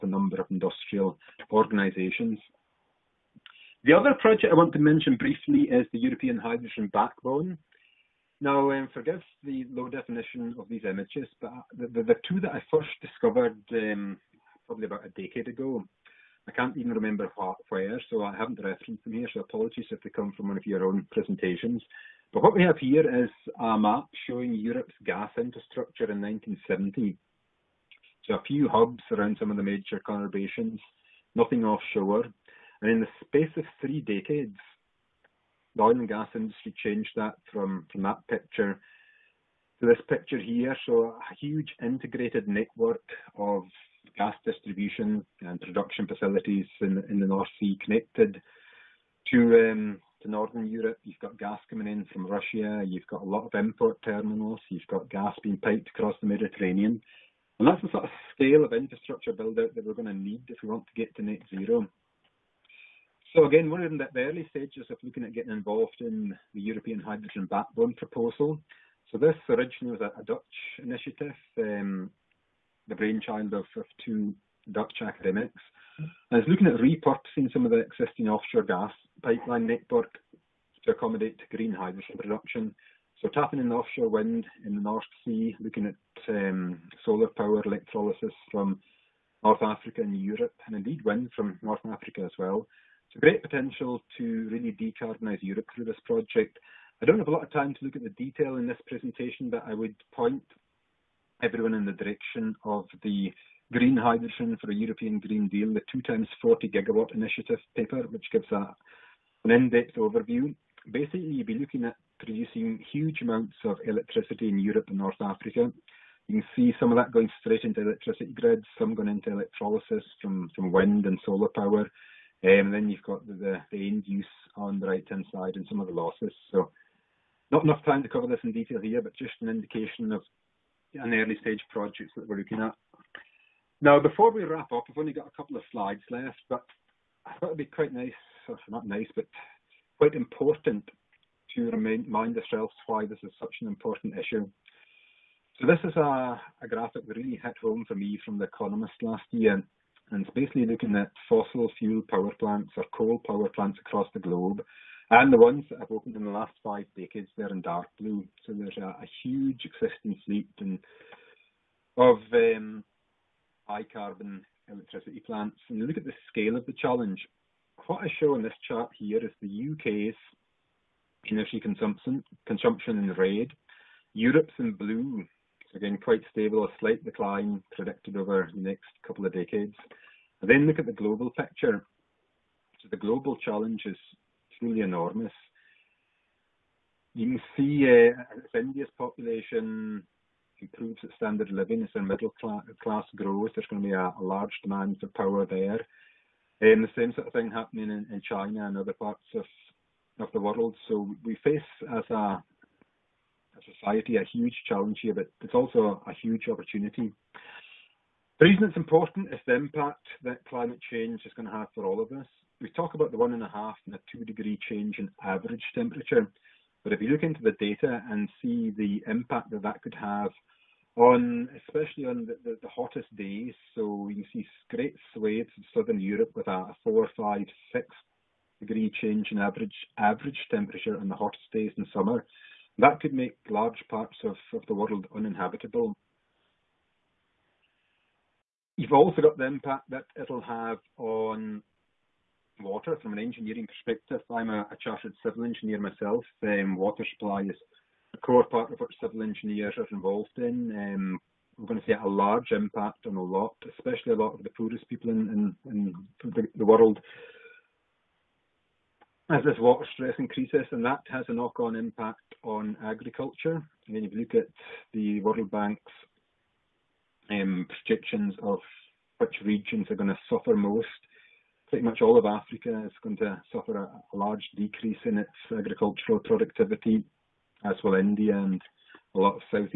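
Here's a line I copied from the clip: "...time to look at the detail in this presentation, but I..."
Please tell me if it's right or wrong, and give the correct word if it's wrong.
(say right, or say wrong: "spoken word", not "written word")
right.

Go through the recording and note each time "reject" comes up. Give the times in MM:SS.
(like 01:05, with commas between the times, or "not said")
not said.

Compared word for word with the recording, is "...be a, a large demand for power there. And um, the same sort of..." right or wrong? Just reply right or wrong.
right.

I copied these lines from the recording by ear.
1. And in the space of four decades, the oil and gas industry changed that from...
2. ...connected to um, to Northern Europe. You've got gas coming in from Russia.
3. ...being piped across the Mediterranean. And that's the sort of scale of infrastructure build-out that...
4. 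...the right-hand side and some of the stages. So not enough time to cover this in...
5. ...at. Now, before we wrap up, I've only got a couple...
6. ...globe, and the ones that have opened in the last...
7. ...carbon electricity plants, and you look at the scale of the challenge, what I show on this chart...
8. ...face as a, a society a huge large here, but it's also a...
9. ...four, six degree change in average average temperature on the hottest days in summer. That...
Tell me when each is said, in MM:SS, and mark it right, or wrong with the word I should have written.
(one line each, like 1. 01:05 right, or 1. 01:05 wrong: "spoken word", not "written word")
1. 00:32 wrong: "three", not "four"
2. 00:47 right
3. 00:55 right
4. 02:04 wrong: "losses", not "stages"
5. 02:12 right
6. 02:34 right
7. 02:43 right
8. 03:21 wrong: "challenge", not "large"
9. 03:47 wrong: "five", not "four".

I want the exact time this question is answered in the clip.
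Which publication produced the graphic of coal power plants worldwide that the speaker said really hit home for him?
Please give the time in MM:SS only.
02:28.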